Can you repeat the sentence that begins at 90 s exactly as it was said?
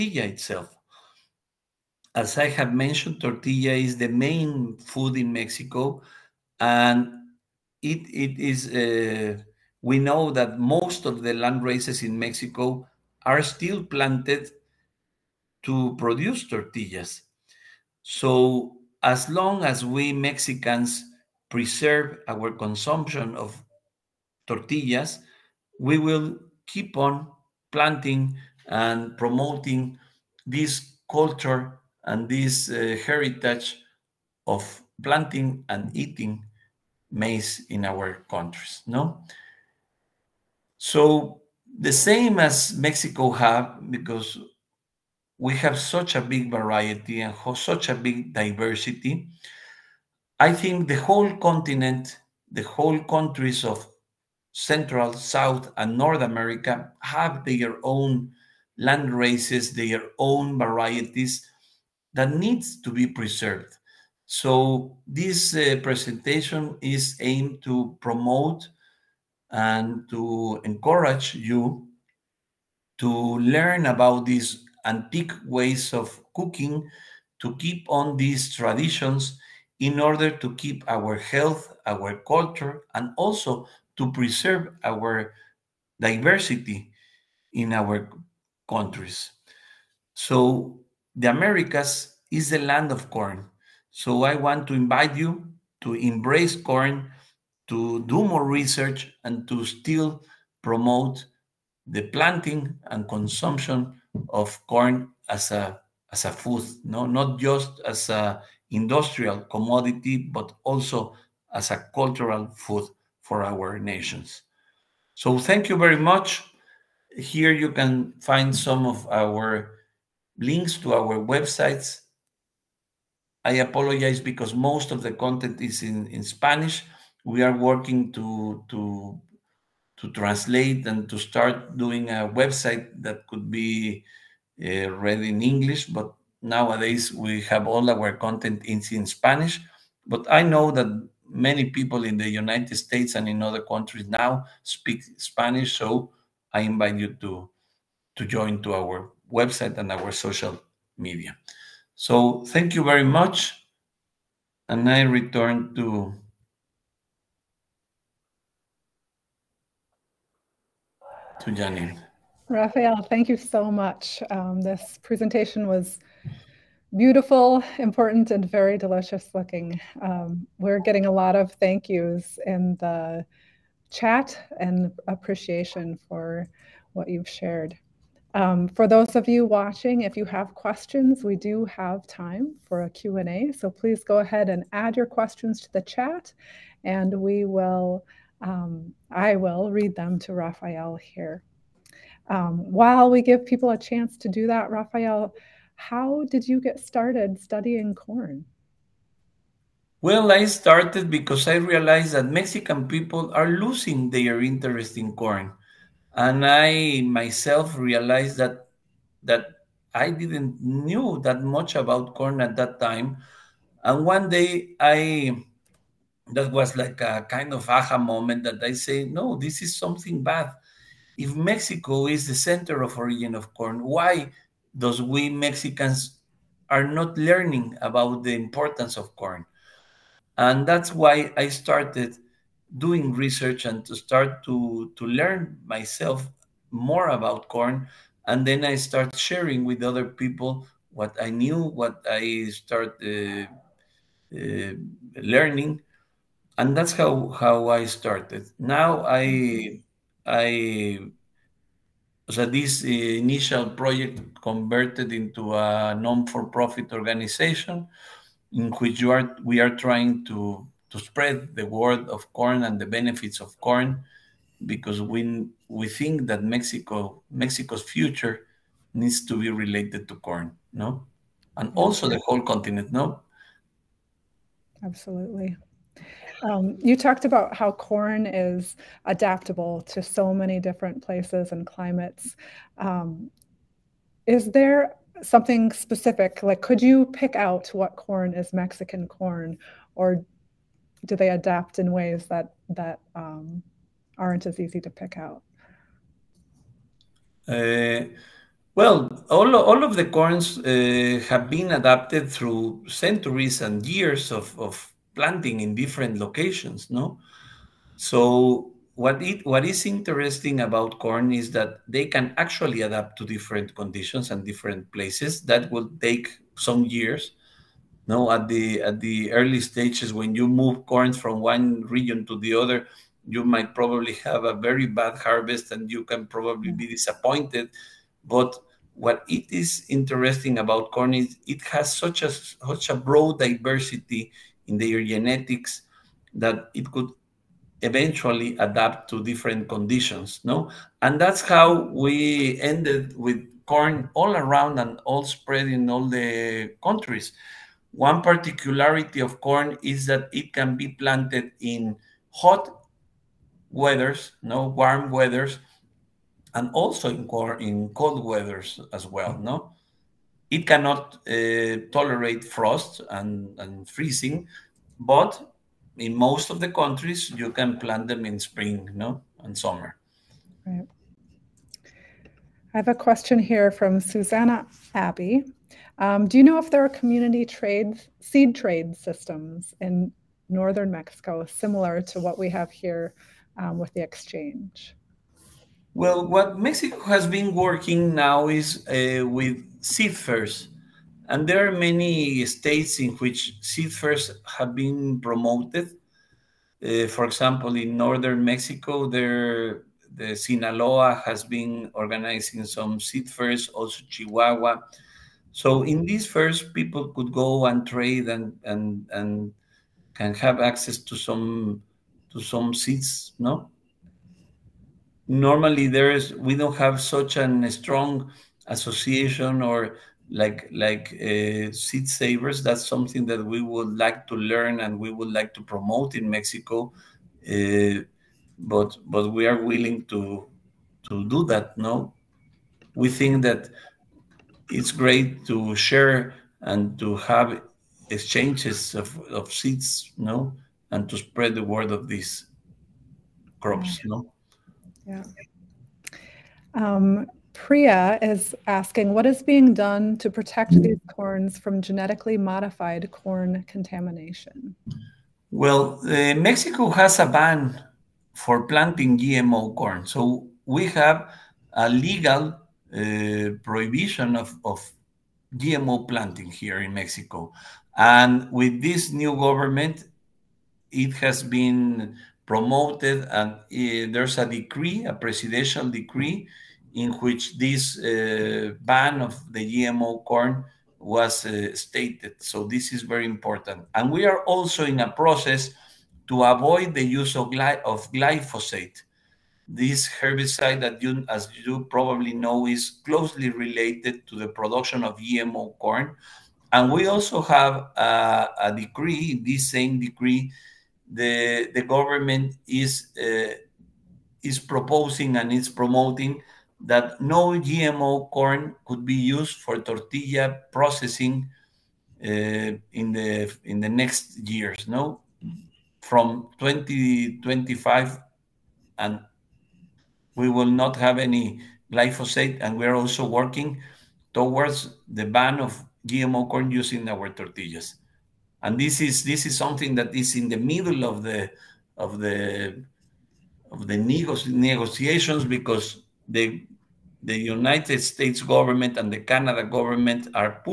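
So, the Americas is the land of corn.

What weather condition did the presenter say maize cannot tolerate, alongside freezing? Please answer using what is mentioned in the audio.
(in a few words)
Frost.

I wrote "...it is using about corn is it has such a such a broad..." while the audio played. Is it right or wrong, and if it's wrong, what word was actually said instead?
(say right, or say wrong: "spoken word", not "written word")
wrong: "interesting", not "using".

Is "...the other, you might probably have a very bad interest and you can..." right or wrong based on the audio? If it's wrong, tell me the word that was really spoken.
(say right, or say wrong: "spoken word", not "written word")
wrong: "harvest", not "interest".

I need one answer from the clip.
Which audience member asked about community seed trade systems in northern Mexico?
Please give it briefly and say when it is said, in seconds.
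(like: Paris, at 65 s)
Susanna Abbey, at 373 s.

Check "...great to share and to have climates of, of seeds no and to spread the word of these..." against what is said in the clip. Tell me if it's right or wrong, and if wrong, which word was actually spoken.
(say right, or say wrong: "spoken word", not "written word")
wrong: "exchanges", not "climates".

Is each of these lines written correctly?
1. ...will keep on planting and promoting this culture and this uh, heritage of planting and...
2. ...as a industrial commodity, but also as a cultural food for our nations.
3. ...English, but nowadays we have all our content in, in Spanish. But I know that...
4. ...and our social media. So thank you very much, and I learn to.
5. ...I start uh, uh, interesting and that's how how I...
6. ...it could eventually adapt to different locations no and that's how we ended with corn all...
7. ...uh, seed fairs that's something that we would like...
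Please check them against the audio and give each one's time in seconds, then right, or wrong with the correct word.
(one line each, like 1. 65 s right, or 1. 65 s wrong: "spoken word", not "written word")
1. 25 s right
2. 107 s right
3. 135 s right
4. 149 s wrong: "return", not "learn"
5. 242 s wrong: "learning", not "interesting"
6. 336 s wrong: "conditions", not "locations"
7. 421 s wrong: "savers", not "fairs".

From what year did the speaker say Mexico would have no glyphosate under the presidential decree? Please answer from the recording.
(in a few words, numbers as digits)
2025.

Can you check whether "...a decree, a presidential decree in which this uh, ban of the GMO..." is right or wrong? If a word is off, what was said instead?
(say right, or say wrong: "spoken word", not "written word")
right.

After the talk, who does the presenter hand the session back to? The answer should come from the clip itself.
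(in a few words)
Janine.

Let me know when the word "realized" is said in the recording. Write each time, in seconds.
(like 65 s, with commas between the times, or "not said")
201 s, 207 s.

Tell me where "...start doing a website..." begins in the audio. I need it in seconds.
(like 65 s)
131 s.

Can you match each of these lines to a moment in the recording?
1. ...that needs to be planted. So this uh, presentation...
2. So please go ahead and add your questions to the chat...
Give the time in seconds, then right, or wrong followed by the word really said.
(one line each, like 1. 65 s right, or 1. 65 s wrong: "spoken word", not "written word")
1. 62 s wrong: "preserved", not "planted"
2. 183 s right.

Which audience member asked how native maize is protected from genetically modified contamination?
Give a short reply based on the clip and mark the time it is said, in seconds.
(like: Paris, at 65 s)
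Priya, at 447 s.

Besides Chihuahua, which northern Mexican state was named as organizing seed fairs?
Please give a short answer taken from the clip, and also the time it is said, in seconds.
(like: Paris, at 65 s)
Sinaloa, at 400 s.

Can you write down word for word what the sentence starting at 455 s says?
Well, uh, Mexico has a ban for planting GMO corn.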